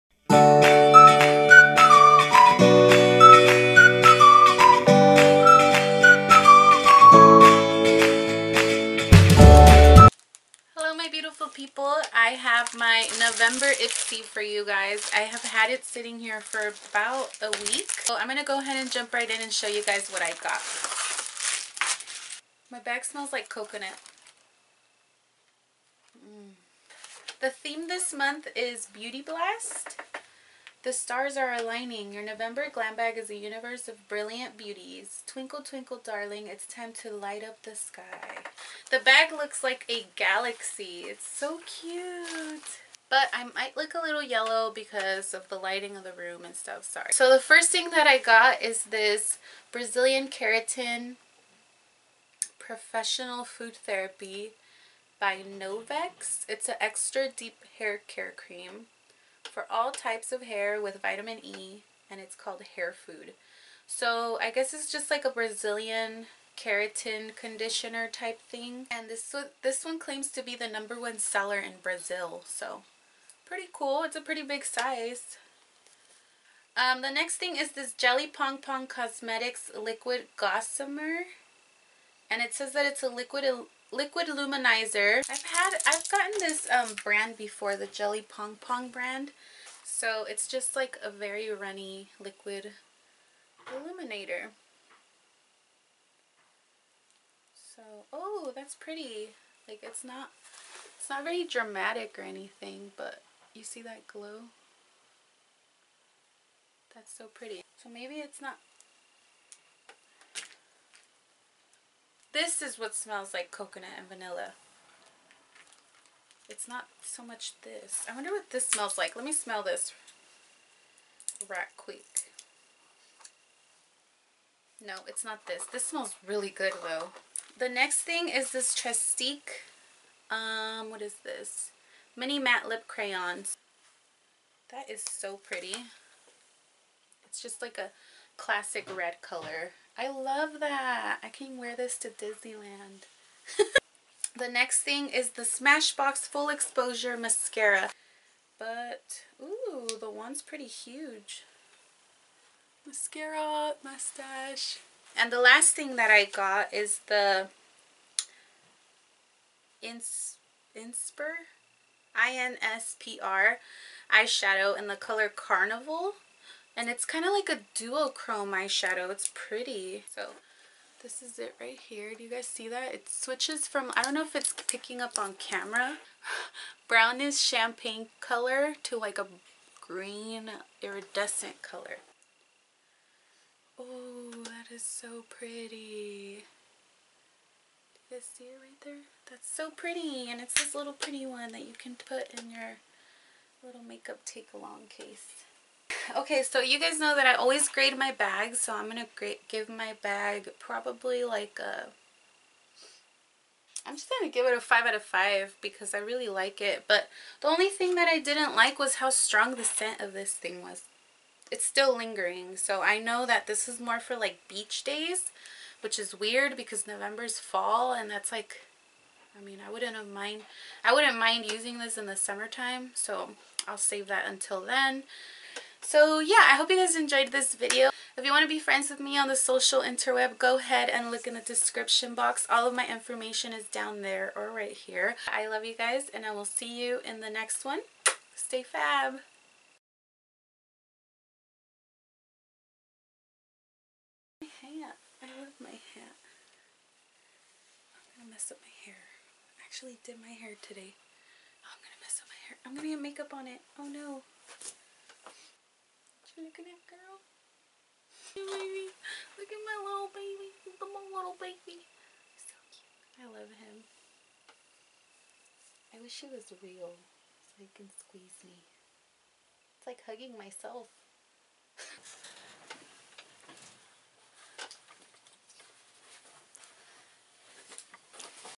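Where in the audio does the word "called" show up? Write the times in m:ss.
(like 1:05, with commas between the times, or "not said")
1:02.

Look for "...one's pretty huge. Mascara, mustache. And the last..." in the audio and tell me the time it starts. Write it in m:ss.
2:30.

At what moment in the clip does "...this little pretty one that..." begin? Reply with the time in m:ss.
3:10.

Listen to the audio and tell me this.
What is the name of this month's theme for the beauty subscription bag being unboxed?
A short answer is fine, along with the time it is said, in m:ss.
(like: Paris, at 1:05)
Beauty Blast, at 0:28.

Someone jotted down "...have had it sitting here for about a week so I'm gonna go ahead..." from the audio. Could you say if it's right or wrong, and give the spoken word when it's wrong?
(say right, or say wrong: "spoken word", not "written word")
right.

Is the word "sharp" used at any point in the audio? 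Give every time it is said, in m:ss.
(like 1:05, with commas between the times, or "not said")
not said.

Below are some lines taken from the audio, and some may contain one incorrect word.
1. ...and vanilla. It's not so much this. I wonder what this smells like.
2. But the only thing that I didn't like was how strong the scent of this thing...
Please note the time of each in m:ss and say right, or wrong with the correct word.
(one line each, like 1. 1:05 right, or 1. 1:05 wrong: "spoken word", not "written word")
1. 1:53 right
2. 3:26 right.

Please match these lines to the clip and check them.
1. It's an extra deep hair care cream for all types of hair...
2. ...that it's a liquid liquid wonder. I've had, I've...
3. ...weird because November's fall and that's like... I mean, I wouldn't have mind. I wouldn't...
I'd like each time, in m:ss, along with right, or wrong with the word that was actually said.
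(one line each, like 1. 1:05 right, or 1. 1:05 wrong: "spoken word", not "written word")
1. 0:56 right
2. 1:22 wrong: "luminizer", not "wonder"
3. 3:36 right.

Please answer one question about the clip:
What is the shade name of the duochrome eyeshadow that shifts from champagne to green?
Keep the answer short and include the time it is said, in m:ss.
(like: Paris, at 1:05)
Carnival, at 2:45.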